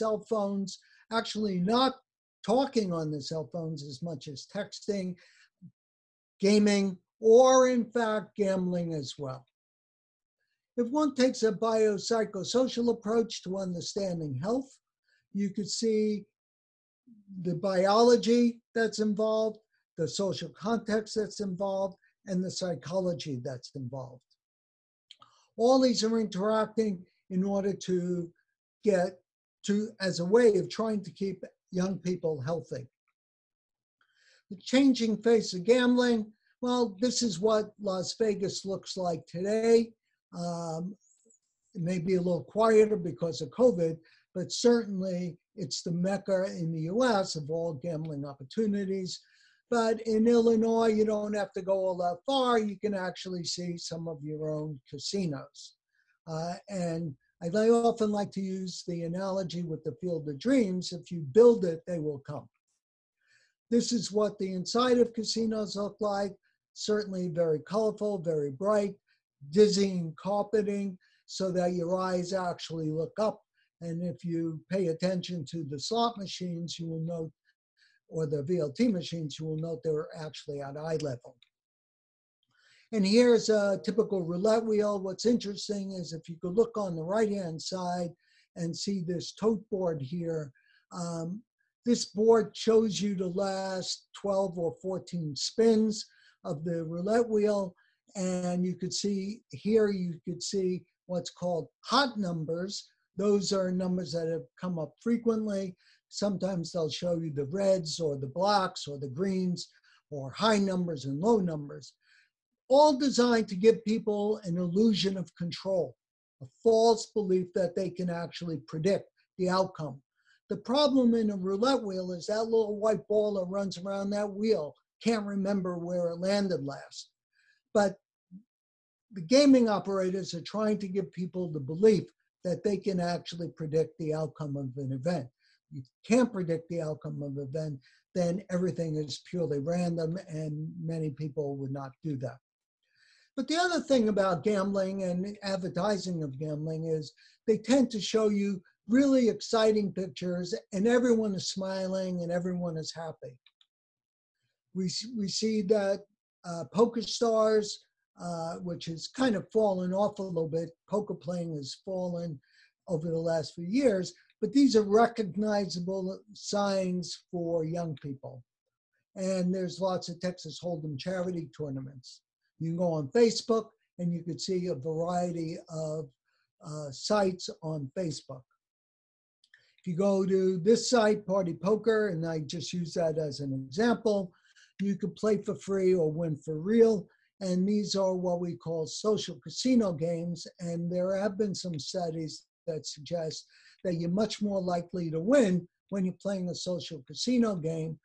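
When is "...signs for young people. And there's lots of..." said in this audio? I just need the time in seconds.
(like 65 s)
166 s.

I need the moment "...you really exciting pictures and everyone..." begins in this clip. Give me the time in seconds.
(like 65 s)
148 s.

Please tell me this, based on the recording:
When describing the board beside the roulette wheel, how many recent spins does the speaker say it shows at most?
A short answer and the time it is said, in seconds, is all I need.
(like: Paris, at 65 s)
14, at 94 s.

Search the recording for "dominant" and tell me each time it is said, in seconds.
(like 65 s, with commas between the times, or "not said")
not said.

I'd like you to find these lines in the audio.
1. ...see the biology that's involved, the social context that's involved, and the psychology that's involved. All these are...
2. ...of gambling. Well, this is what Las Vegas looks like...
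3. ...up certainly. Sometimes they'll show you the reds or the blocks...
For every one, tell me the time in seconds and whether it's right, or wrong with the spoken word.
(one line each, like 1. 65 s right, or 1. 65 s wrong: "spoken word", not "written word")
1. 15 s right
2. 35 s right
3. 104 s wrong: "frequently", not "certainly".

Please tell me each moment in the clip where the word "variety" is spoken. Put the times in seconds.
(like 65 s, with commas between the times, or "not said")
174 s.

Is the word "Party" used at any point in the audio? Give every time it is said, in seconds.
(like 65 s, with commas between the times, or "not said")
181 s.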